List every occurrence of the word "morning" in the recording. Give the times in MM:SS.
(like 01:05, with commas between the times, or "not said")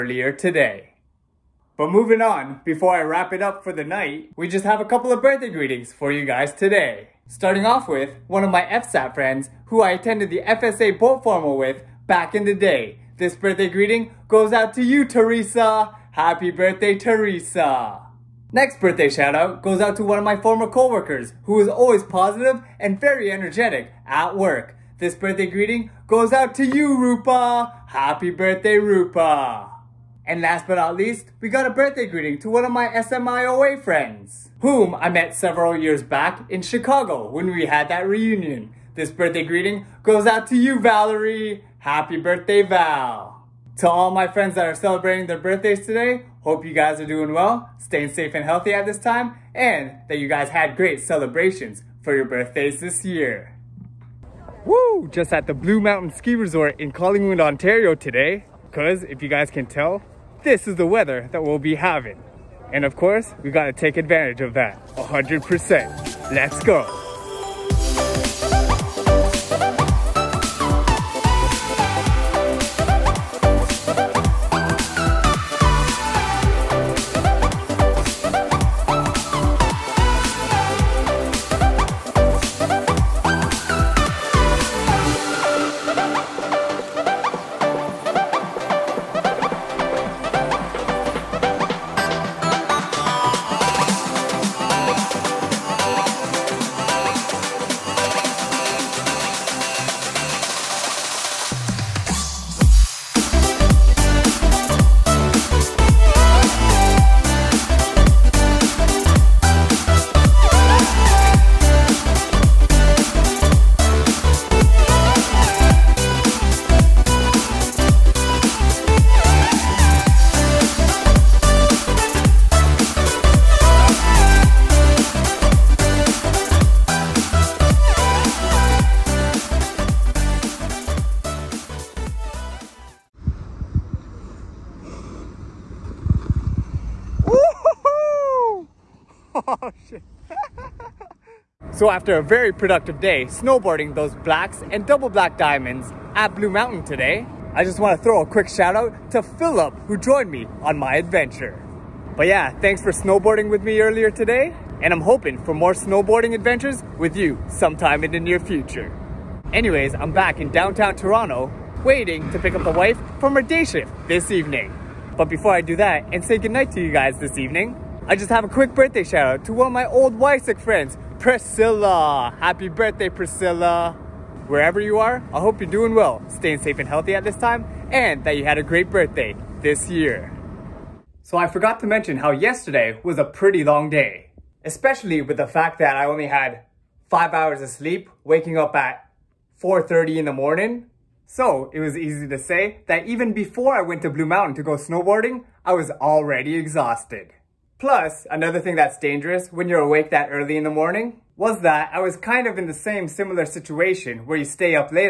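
03:10, 03:20.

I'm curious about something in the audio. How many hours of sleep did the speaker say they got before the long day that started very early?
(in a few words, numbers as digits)
5.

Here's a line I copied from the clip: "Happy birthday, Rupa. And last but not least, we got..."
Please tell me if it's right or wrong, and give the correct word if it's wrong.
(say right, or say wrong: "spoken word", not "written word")
right.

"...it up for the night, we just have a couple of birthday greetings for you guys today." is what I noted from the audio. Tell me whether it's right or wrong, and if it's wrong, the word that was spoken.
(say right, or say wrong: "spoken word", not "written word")
right.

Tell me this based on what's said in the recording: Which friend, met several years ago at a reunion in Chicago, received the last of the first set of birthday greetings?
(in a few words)
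Valerie.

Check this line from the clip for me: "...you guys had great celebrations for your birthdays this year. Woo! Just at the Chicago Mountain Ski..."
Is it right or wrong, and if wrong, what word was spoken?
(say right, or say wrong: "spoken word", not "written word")
wrong: "Blue", not "Chicago".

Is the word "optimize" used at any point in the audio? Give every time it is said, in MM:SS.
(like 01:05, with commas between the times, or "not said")
not said.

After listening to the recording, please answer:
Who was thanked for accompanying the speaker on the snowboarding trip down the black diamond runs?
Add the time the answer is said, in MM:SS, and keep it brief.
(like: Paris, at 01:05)
Philip, at 02:29.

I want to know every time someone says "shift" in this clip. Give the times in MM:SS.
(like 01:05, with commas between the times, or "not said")
02:43.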